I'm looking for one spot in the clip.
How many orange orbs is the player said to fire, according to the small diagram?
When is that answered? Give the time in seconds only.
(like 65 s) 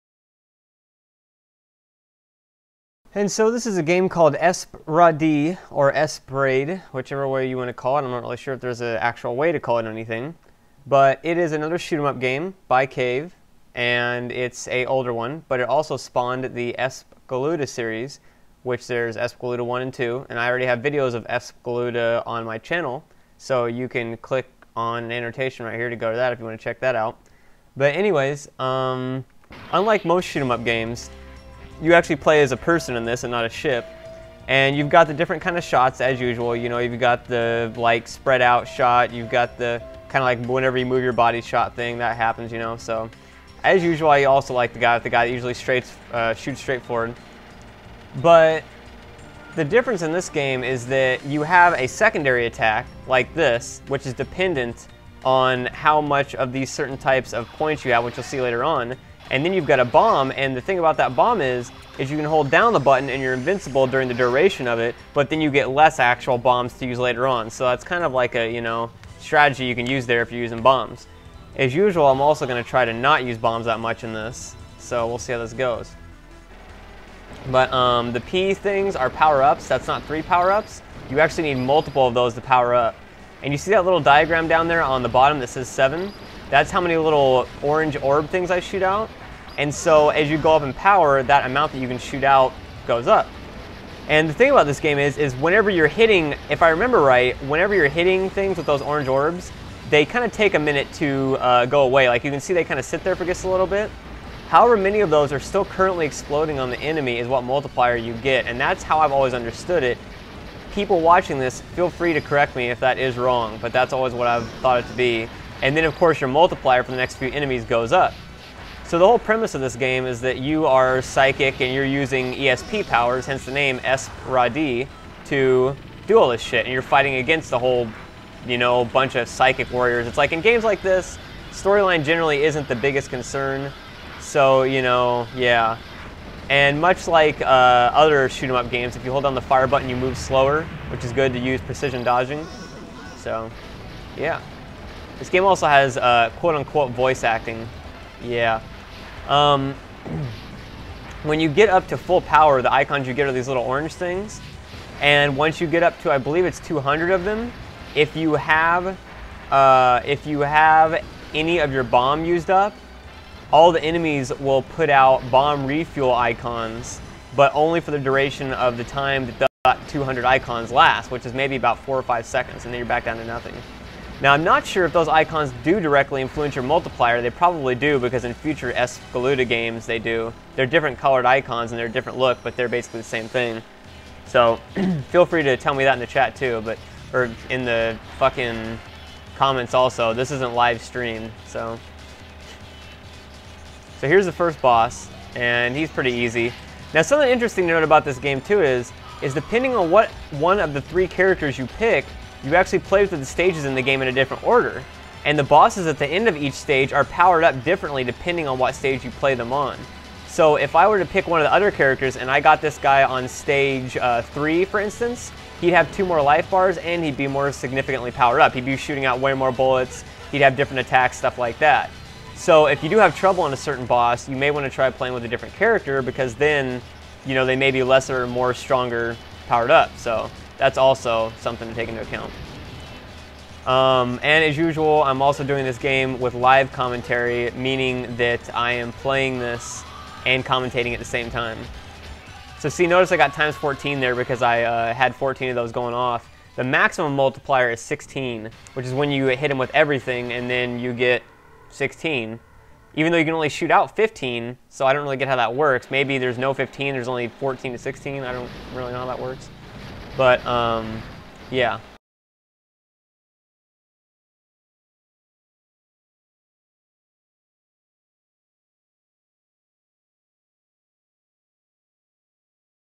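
85 s.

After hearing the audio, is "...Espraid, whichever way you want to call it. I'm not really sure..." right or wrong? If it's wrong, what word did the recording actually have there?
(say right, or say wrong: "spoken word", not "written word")
right.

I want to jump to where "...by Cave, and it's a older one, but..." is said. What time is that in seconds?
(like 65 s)
12 s.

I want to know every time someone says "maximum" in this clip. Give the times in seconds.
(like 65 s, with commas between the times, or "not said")
246 s.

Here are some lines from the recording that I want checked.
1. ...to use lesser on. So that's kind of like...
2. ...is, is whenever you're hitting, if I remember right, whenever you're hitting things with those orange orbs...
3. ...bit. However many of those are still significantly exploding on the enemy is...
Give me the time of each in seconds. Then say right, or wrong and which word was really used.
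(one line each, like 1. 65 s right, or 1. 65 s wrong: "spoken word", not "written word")
1. 66 s wrong: "later", not "lesser"
2. 94 s right
3. 103 s wrong: "currently", not "significantly".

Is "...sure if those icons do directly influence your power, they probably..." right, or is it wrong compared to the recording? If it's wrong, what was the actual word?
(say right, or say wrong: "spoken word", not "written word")
wrong: "multiplier", not "power".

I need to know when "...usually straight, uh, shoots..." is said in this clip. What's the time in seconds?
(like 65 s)
45 s.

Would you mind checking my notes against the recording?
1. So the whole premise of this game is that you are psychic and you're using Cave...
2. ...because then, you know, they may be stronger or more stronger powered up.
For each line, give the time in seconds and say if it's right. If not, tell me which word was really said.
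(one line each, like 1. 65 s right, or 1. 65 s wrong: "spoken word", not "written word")
1. 118 s wrong: "ESP", not "Cave"
2. 226 s wrong: "lesser", not "stronger".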